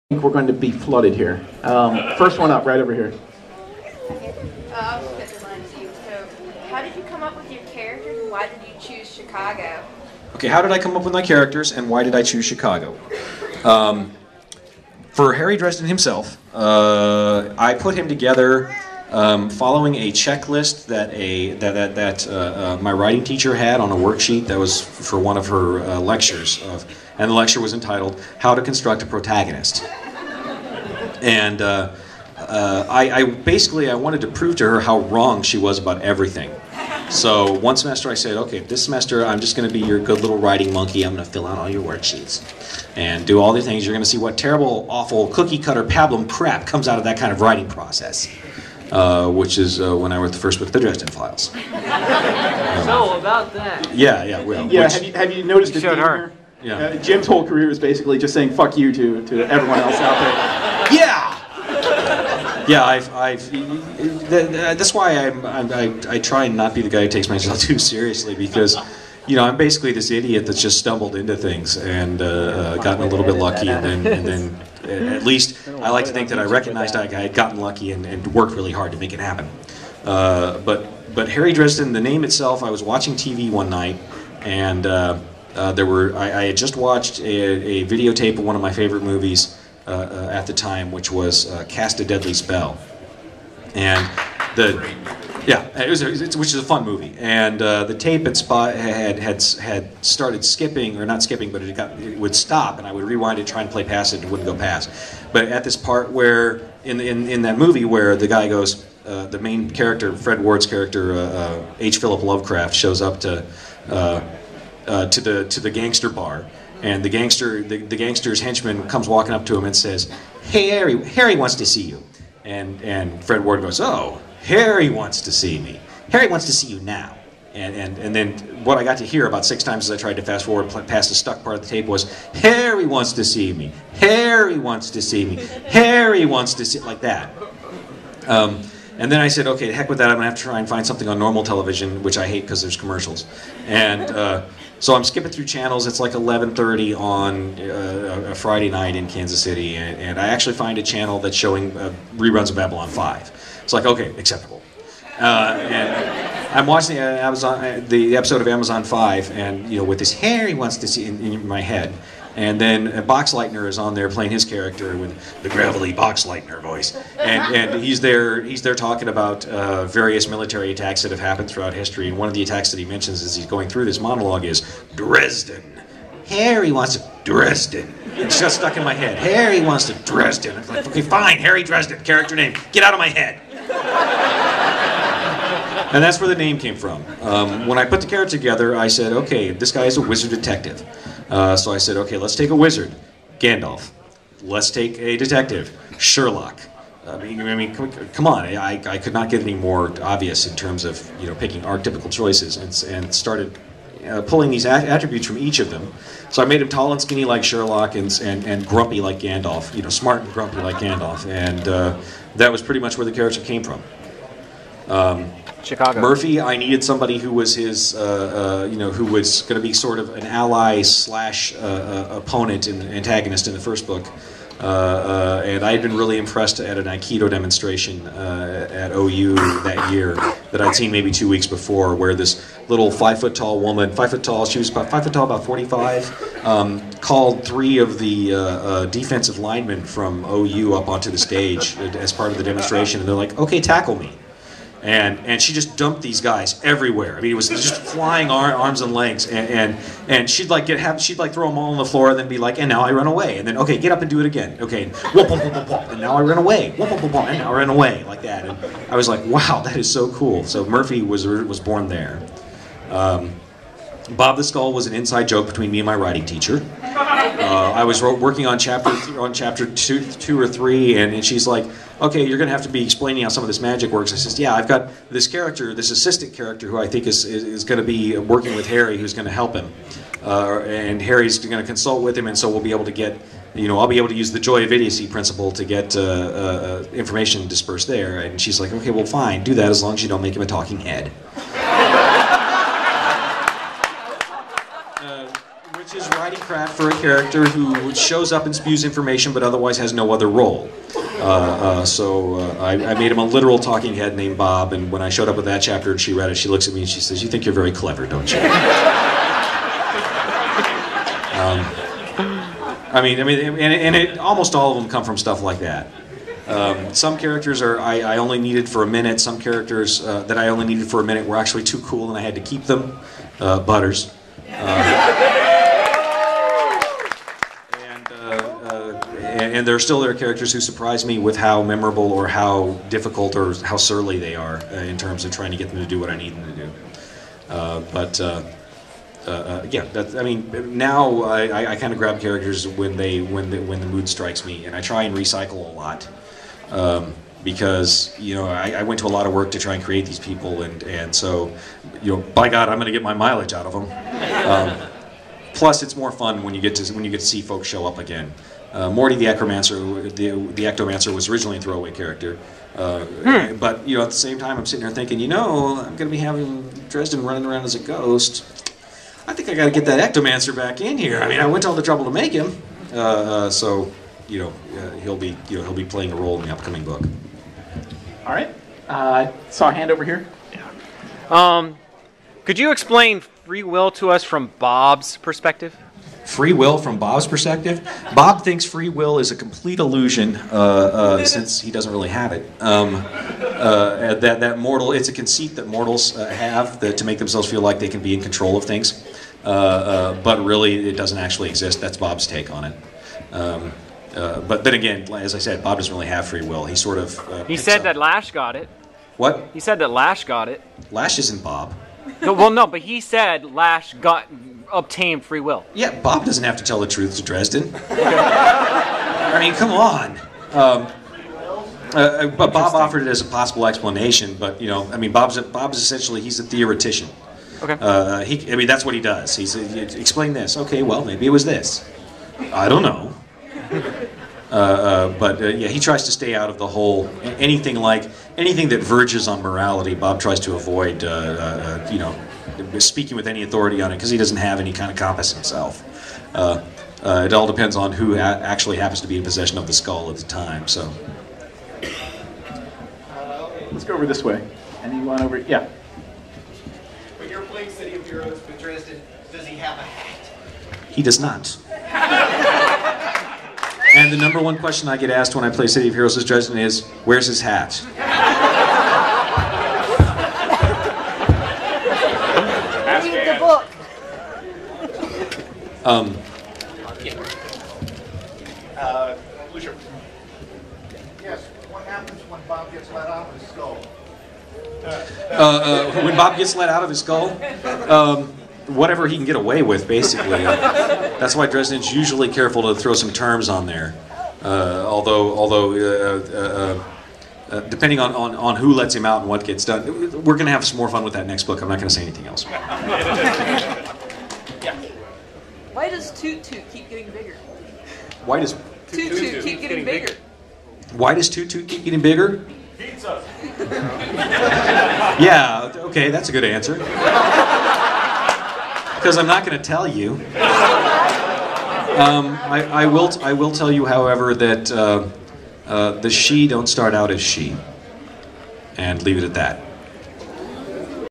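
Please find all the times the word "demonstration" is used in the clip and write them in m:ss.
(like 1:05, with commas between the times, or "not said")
3:47, 4:02.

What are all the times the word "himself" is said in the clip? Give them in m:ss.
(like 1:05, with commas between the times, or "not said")
0:15, 7:25.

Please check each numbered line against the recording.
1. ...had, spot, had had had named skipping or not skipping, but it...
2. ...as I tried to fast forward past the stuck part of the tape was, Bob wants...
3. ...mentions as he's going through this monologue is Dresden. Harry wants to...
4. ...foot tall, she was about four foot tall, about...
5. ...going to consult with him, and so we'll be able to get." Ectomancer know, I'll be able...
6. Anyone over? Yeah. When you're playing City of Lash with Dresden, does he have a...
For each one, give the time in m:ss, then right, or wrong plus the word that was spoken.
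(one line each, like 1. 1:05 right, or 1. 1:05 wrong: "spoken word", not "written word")
1. 1:38 wrong: "started", not "named"
2. 2:09 wrong: "Harry", not "Bob"
3. 2:52 right
4. 3:54 wrong: "five", not "four"
5. 4:41 wrong: "You", not "Ectomancer"
6. 7:34 wrong: "Heroes", not "Lash".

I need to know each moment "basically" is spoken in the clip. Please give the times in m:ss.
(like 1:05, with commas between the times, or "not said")
0:33, 0:57, 1:09, 8:09.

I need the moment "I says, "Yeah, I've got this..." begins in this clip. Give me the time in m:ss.
4:34.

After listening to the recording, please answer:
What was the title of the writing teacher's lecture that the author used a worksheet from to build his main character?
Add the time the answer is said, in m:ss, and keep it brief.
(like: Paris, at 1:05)
How to Construct a Protagonist, at 0:28.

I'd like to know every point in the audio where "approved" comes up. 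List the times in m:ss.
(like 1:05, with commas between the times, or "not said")
not said.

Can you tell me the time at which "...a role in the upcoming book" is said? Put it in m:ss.
6:16.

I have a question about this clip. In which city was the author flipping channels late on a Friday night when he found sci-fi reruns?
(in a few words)
Kansas City.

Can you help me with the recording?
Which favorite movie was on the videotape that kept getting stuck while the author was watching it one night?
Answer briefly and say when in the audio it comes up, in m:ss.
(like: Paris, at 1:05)
Cast a Deadly Spell, at 1:31.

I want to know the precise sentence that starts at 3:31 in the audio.
And uh, that was pretty much where the character came from.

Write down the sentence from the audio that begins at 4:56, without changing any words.
craft for a character who shows up and spews information but otherwise has no other role.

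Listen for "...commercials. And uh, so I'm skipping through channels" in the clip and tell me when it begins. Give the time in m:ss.
2:22.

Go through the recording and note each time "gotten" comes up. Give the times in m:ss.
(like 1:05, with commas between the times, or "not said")
1:12, 1:17.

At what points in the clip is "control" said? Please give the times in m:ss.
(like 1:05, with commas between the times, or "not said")
6:38.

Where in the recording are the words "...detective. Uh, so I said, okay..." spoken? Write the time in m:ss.
3:10.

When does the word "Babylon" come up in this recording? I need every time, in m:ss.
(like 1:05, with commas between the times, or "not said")
2:32, 2:38.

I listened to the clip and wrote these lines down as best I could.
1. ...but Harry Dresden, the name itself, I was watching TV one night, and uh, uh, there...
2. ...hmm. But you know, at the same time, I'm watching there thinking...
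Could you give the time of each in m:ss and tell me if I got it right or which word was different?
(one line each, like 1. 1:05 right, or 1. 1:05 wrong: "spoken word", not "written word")
1. 1:21 right
2. 6:03 wrong: "sitting", not "watching".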